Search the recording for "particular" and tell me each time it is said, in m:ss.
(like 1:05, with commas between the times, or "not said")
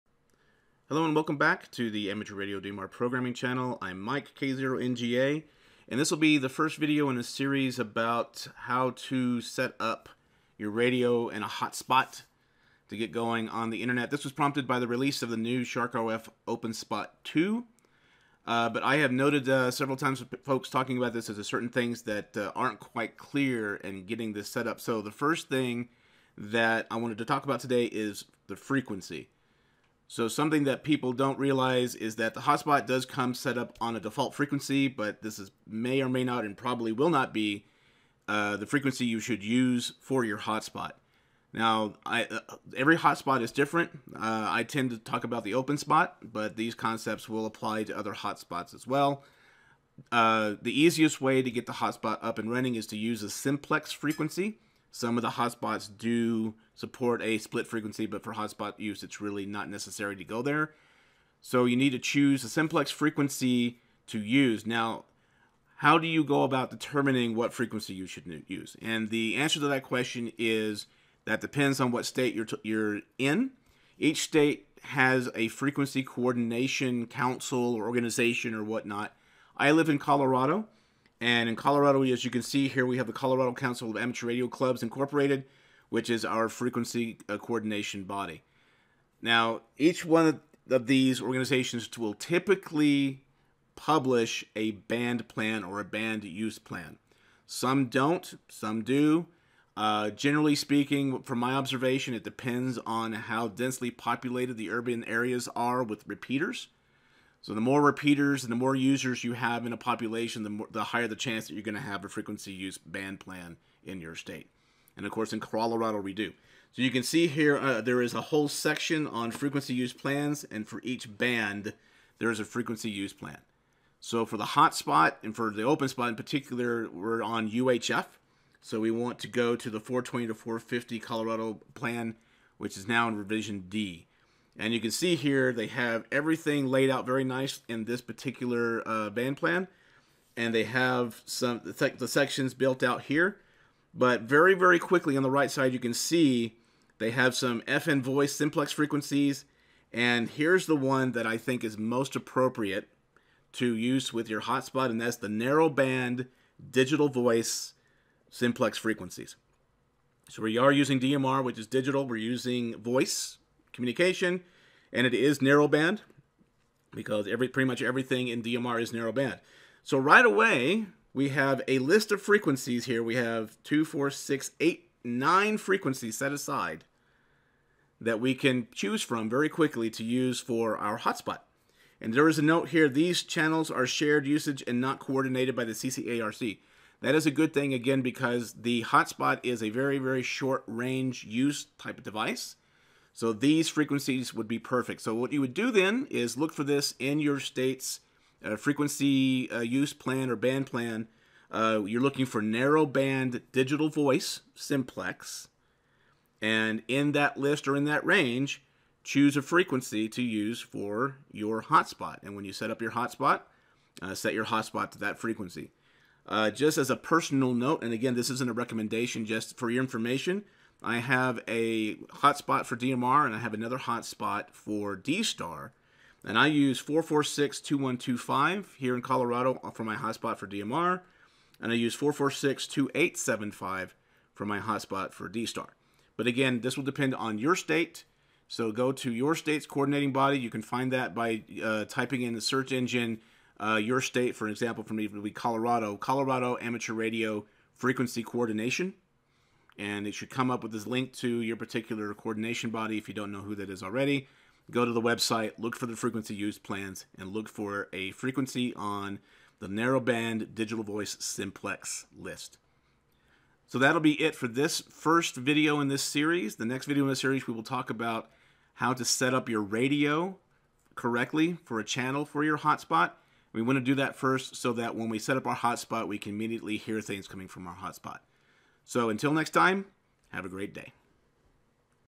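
2:06, 2:18, 4:11.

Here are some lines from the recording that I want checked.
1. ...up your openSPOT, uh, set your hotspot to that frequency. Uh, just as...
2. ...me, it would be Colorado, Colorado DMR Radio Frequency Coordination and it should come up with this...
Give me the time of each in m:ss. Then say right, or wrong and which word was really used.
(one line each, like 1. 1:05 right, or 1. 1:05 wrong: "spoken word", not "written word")
1. 3:32 wrong: "hotspot", not "openSPOT"
2. 4:04 wrong: "Amateur", not "DMR".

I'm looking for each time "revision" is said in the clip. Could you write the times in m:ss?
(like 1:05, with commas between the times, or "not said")
2:13.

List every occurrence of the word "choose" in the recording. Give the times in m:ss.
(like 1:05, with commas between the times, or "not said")
1:01, 2:58, 3:29.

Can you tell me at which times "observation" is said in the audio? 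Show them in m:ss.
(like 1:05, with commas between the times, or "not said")
1:41.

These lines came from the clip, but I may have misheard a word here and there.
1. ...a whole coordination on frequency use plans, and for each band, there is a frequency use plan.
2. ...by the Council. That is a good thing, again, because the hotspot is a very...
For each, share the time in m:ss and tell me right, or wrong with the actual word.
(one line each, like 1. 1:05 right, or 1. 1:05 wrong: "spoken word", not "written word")
1. 1:58 wrong: "section", not "coordination"
2. 3:05 wrong: "CCARC", not "Council".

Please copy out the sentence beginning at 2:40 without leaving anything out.
So we are using DMR, which is digital.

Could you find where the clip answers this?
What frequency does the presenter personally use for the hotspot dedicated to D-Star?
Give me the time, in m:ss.
3:51.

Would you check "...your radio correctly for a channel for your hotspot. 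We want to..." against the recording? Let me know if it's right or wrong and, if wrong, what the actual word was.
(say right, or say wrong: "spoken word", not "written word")
right.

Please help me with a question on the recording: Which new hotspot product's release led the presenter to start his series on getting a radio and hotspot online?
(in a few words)
SharkRF OpenSpot 2.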